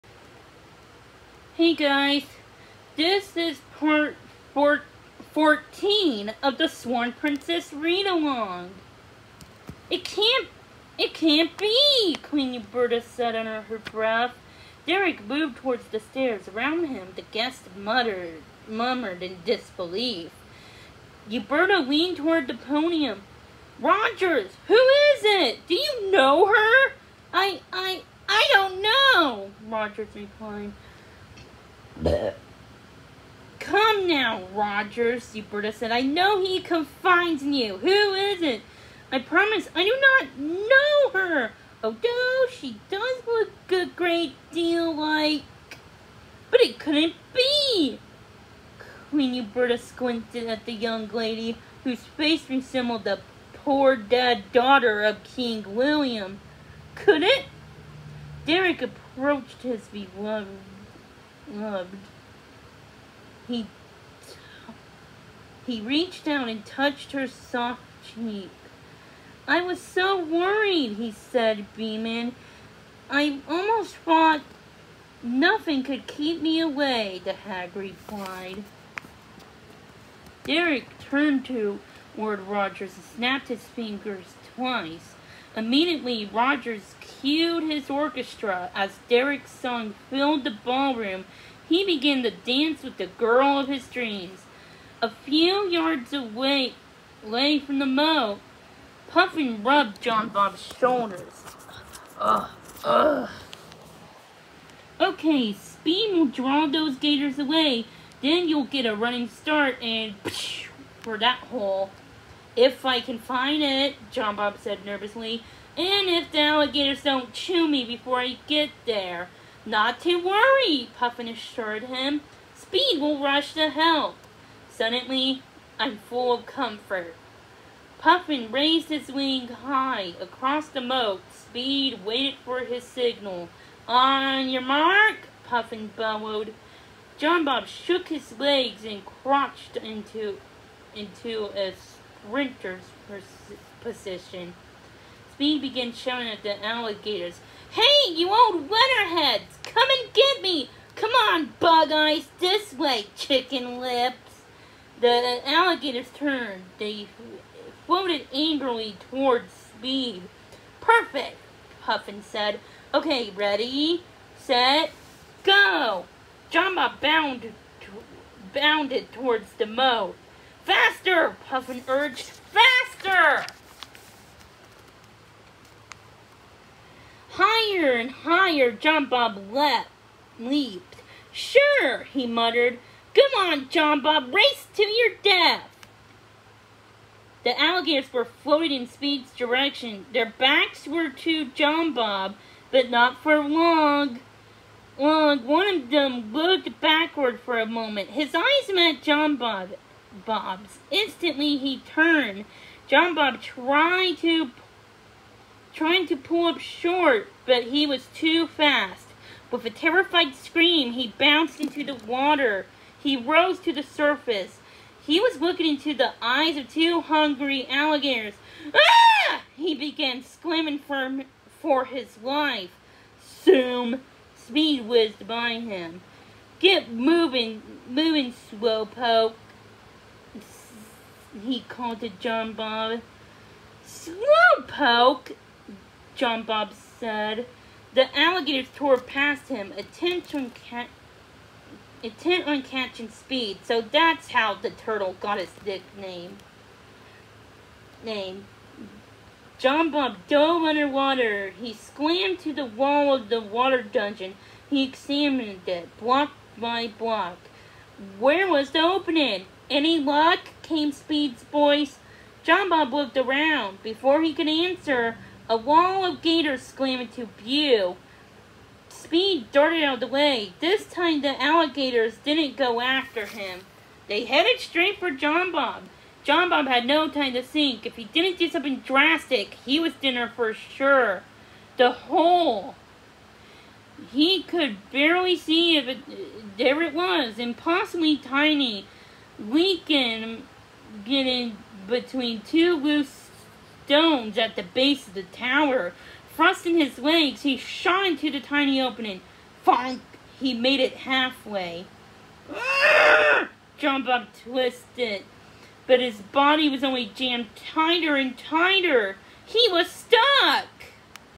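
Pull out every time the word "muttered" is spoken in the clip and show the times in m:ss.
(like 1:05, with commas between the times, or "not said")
0:17, 3:02.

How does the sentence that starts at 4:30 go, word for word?
This time the alligators didn't go after him.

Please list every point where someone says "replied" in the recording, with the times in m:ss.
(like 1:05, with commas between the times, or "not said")
0:30, 1:17.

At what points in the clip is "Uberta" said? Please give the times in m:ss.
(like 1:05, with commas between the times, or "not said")
0:12, 0:21, 0:35, 0:49.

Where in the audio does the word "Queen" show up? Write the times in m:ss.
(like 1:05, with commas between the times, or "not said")
0:12, 0:49.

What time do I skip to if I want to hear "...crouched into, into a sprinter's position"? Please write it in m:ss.
2:19.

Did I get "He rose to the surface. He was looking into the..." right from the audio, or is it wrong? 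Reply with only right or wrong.
right.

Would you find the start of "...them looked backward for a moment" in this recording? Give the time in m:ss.
3:15.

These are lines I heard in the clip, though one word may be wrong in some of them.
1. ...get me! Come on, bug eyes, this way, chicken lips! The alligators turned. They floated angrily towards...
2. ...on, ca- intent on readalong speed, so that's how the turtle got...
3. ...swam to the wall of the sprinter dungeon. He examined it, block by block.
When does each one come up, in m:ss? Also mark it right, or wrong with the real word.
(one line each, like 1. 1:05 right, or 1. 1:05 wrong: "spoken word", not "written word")
1. 2:30 right
2. 4:00 wrong: "catching", not "readalong"
3. 4:11 wrong: "water", not "sprinter".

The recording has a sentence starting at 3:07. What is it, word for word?
The alligators were floating in Speed's direction.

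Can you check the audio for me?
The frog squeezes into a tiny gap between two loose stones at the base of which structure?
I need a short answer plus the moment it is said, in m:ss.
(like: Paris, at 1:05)
the tower, at 4:55.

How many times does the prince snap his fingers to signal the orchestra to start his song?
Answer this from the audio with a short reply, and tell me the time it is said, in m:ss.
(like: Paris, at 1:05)
Twice, at 1:24.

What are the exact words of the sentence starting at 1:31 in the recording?
He began to dance with the girl of his dreams.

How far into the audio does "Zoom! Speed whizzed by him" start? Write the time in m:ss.
3:43.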